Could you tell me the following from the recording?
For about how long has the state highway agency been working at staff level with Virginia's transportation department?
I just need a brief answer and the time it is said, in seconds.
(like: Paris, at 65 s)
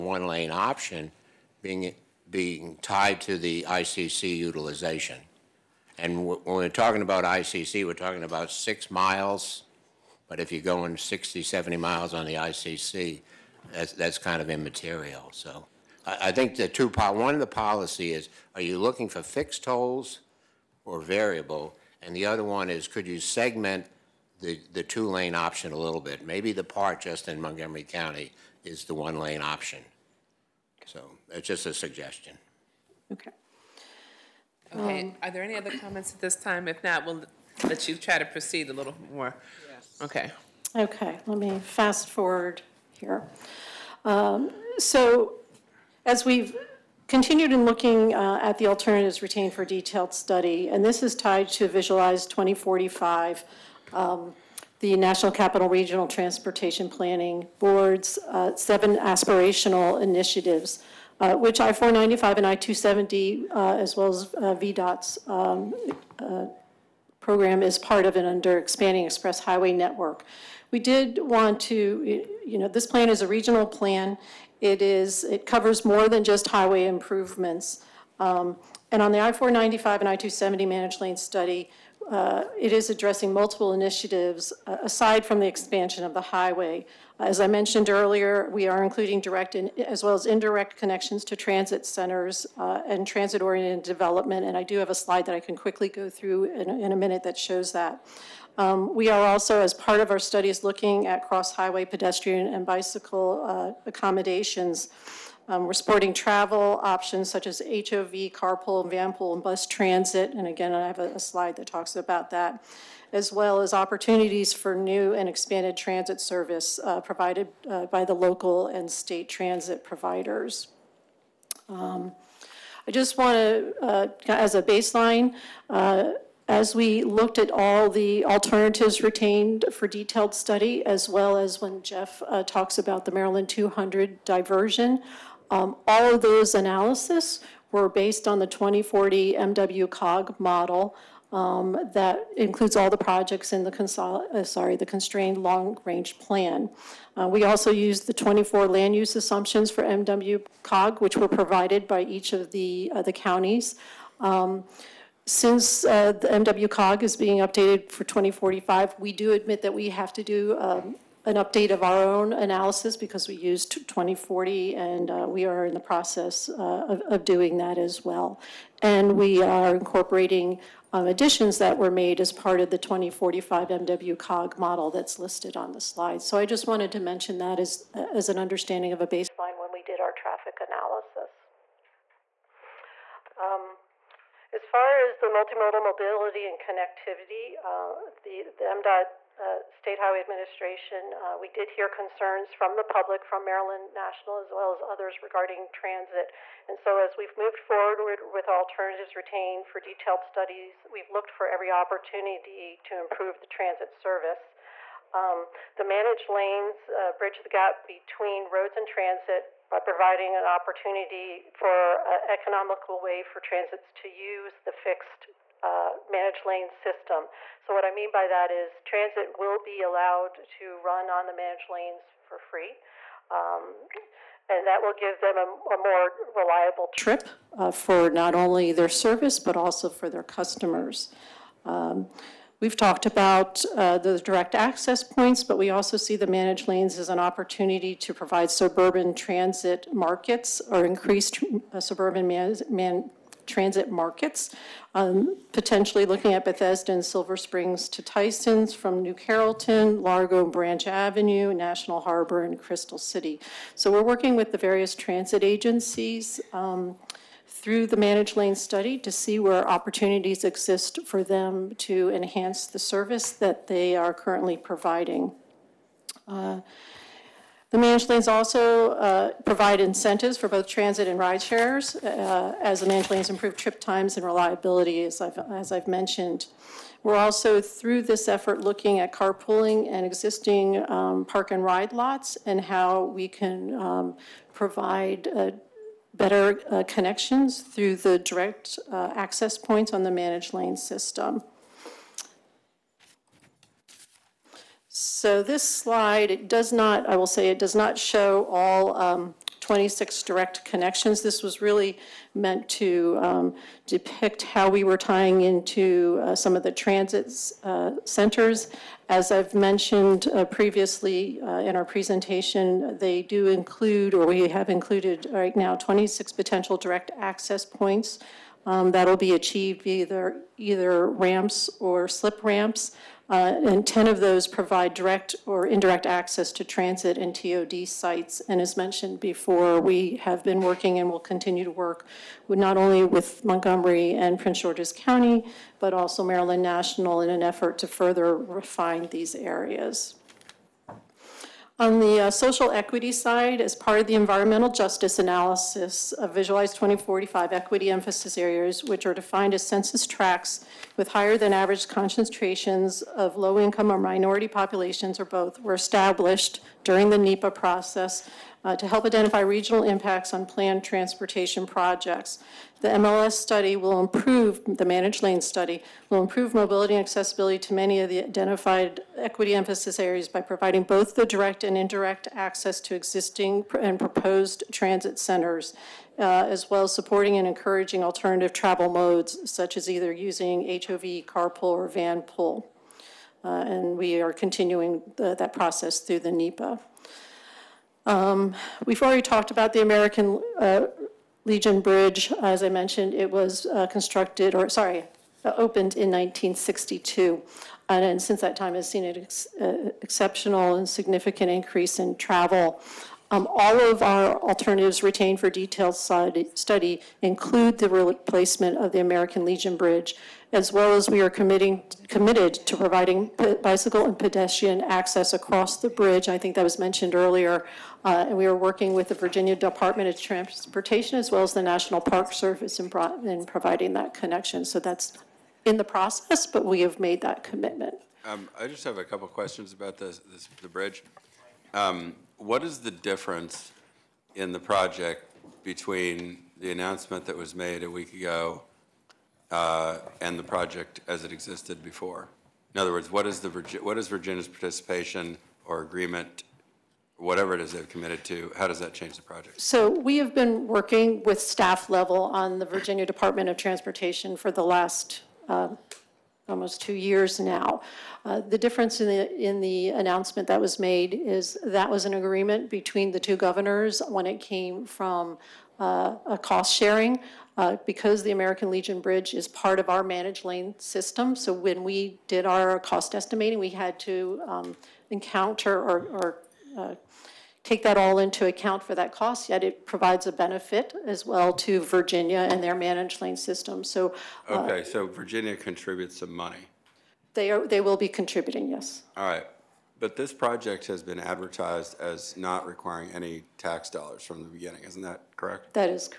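Almost two years, at 456 s.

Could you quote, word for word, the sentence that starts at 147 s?
Uh, we also used the 24 land use assumptions for MW COG, which were provided by each of the uh, the counties.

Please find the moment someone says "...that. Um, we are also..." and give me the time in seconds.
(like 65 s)
97 s.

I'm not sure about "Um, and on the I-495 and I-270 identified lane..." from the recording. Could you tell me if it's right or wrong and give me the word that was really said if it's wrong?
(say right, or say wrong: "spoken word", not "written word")
wrong: "managed", not "identified".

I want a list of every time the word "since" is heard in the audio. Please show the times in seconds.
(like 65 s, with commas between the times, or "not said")
155 s, 398 s.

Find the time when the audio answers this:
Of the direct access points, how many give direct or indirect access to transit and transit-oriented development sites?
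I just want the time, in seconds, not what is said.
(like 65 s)
323 s.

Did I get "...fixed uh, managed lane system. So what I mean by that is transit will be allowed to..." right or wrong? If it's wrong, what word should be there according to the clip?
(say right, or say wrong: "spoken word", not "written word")
right.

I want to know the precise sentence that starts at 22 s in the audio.
And the other one is could you segment the, the two lane option a little bit?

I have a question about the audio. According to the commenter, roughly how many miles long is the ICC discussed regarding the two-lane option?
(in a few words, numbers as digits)
6 miles.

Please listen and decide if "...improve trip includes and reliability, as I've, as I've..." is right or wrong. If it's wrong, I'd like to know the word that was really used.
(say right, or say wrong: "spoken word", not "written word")
wrong: "times", not "includes".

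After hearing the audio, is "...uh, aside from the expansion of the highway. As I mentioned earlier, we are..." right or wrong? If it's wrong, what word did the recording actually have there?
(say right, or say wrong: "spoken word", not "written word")
right.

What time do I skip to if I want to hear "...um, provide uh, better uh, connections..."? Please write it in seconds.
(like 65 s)
283 s.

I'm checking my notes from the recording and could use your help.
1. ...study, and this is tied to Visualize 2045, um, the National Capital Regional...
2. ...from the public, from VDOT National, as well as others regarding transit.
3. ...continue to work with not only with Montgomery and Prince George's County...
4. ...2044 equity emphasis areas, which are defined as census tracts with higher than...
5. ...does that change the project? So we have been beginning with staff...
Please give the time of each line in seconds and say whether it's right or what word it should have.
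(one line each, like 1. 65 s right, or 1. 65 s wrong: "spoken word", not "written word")
1. 50 s right
2. 192 s wrong: "Maryland", not "VDOT"
3. 331 s right
4. 346 s wrong: "2045", not "2044"
5. 448 s wrong: "working", not "beginning".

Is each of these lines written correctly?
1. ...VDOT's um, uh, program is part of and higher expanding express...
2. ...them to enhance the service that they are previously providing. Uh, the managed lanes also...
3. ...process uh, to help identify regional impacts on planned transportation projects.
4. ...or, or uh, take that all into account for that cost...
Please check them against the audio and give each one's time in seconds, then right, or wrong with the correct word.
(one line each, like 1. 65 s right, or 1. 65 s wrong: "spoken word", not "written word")
1. 64 s wrong: "under", not "higher"
2. 261 s wrong: "currently", not "previously"
3. 357 s right
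4. 475 s right.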